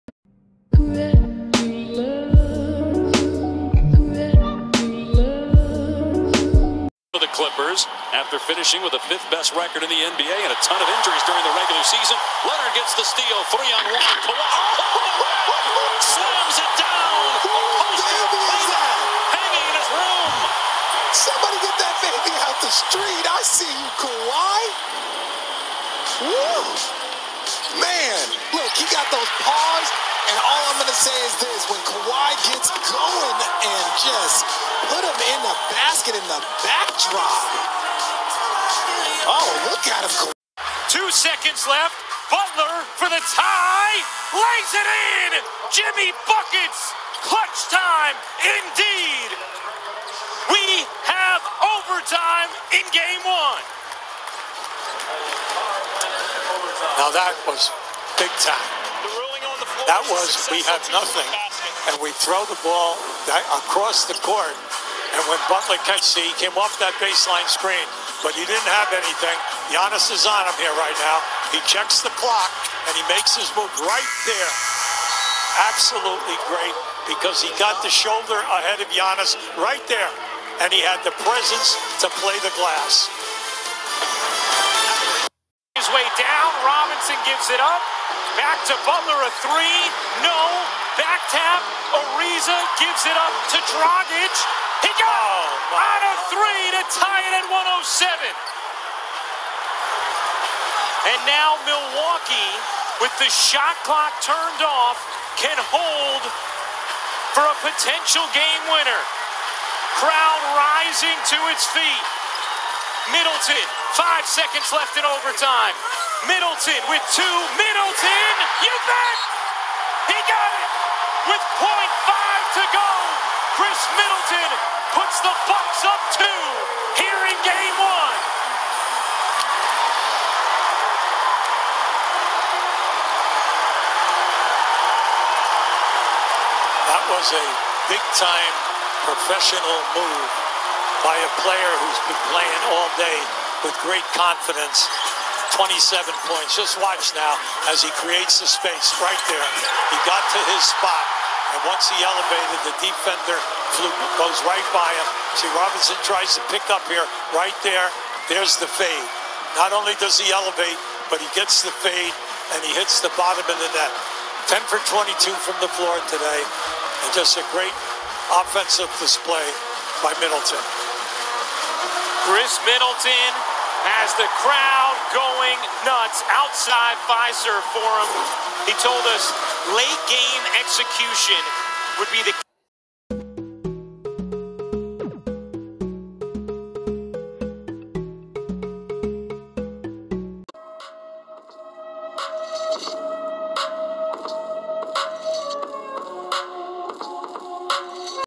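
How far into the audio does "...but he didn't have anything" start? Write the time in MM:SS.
01:08.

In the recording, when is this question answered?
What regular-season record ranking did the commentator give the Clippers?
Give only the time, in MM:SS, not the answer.
00:09.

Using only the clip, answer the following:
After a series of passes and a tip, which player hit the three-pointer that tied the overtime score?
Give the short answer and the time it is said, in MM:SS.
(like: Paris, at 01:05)
Dragic, at 01:33.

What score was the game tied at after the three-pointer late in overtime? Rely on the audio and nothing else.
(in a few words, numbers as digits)
107.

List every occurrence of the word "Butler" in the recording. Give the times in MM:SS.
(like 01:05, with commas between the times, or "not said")
00:42, 01:05, 01:28.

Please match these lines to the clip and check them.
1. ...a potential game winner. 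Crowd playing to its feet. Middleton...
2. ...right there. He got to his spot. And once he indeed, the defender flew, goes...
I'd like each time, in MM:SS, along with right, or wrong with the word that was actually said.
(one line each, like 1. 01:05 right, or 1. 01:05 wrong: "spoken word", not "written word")
1. 01:47 wrong: "rising", not "playing"
2. 02:29 wrong: "elevated", not "indeed".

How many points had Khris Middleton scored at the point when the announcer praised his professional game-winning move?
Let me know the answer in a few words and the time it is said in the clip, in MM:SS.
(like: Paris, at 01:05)
27, at 02:25.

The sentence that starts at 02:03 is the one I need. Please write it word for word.
Khris Middleton puts the Bucks up two here in game one.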